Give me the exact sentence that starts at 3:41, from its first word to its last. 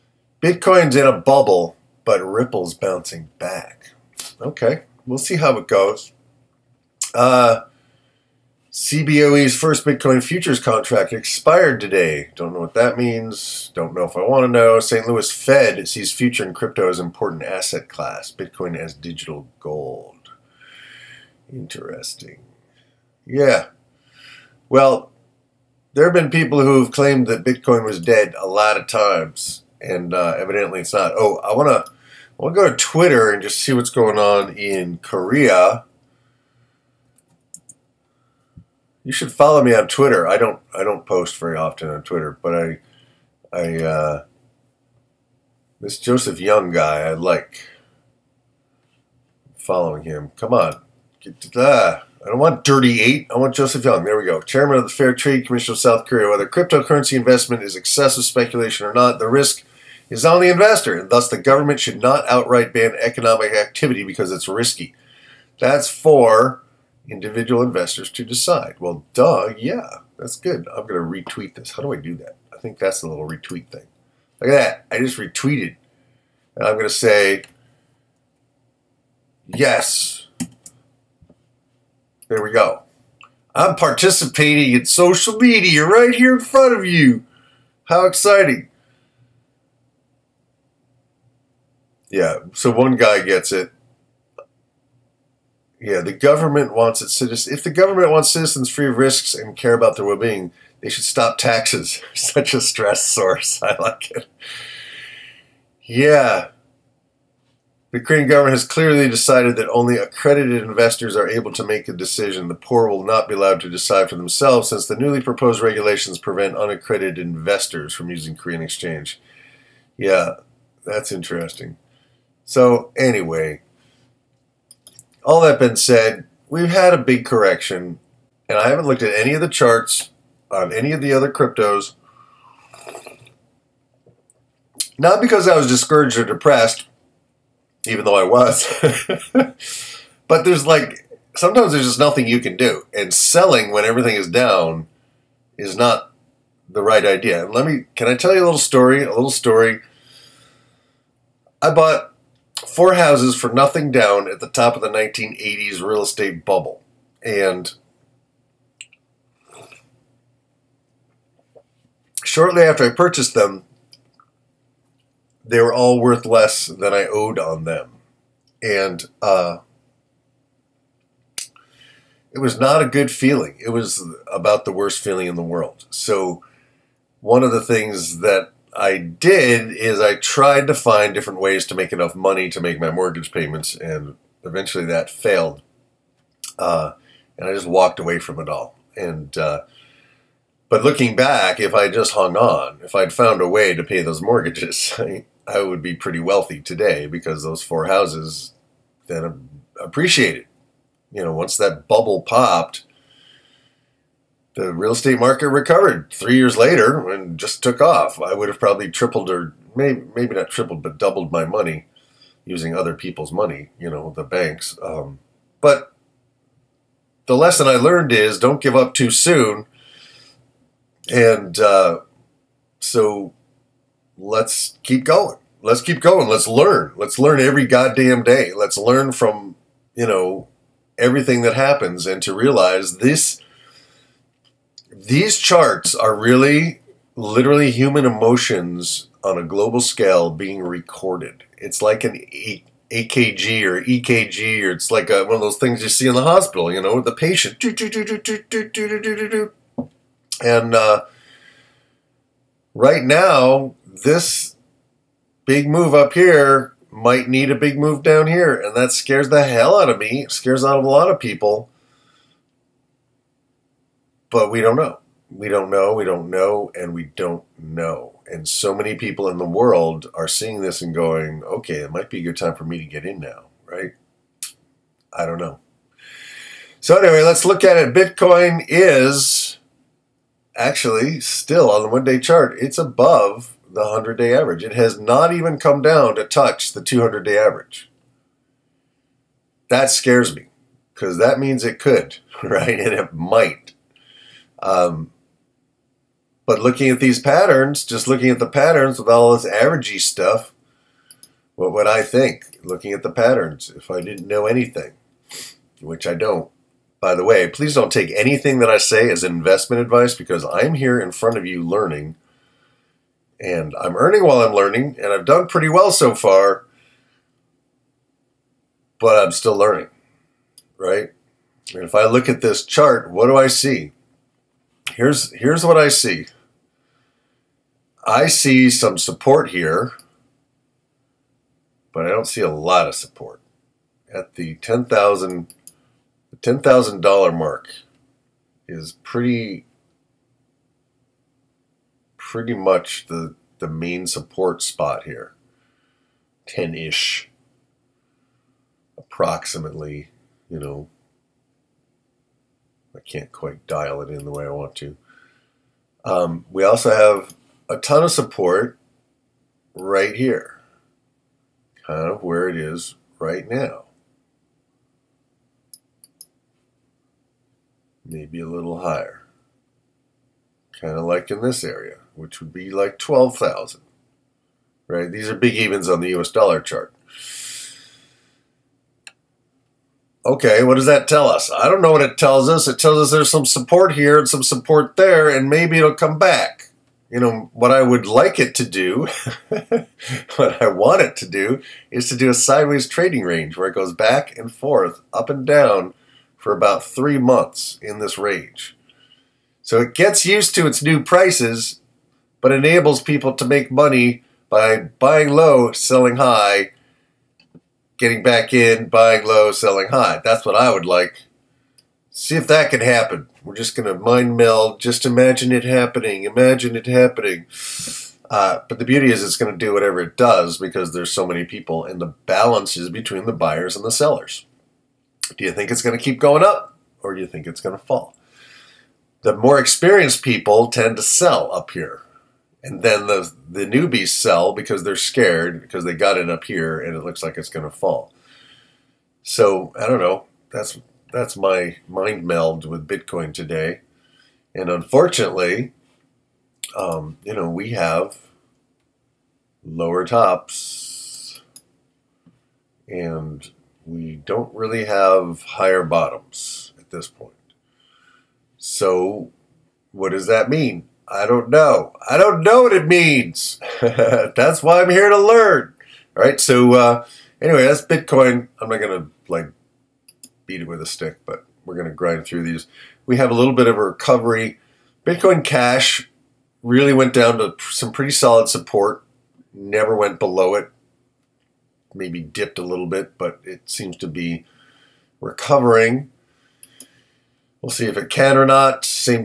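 And uh, so let's keep going.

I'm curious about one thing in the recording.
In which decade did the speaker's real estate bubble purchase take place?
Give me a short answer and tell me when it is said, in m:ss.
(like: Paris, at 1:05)
1980s, at 2:34.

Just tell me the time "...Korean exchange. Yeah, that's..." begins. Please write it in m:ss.
1:58.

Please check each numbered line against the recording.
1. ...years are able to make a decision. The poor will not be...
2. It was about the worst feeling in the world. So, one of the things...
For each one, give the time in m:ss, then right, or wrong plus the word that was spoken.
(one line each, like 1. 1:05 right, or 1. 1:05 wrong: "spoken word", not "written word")
1. 1:50 wrong: "investors", not "years"
2. 2:53 right.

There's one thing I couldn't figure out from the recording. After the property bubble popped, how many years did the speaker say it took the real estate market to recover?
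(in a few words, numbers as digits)
3.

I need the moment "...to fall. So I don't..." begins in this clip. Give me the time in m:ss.
7:17.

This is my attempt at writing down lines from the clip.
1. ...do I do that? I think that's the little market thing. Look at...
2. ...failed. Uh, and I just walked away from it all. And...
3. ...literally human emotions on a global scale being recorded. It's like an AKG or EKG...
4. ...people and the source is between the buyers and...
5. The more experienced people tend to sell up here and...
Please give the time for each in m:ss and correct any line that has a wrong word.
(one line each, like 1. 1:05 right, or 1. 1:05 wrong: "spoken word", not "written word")
1. 1:11 wrong: "retweet", not "market"
2. 3:05 right
3. 3:57 right
4. 7:01 wrong: "balance", not "source"
5. 7:09 right.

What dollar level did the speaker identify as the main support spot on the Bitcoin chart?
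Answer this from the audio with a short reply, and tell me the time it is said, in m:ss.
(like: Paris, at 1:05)
$10,000, at 5:36.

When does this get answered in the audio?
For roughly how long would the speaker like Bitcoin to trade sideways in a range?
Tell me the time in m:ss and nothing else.
6:36.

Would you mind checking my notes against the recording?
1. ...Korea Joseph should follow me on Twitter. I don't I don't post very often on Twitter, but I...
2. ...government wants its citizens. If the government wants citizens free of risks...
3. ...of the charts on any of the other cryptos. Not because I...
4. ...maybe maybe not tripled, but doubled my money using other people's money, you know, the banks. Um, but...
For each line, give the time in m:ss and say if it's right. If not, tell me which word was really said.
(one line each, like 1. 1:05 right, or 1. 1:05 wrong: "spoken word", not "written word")
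1. 0:34 wrong: "You", not "Joseph"
2. 1:36 right
3. 2:09 right
4. 3:29 right.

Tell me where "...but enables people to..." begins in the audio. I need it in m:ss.
6:42.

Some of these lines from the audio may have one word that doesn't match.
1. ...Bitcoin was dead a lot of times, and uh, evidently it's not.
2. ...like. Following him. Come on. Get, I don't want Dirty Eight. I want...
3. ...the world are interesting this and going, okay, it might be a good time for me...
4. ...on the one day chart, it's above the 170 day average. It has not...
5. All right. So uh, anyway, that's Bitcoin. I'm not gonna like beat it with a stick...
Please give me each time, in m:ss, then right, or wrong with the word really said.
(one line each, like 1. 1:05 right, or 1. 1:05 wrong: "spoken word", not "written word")
1. 0:27 right
2. 0:47 right
3. 4:29 wrong: "seeing", not "interesting"
4. 4:41 wrong: "100", not "170"
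5. 7:46 right.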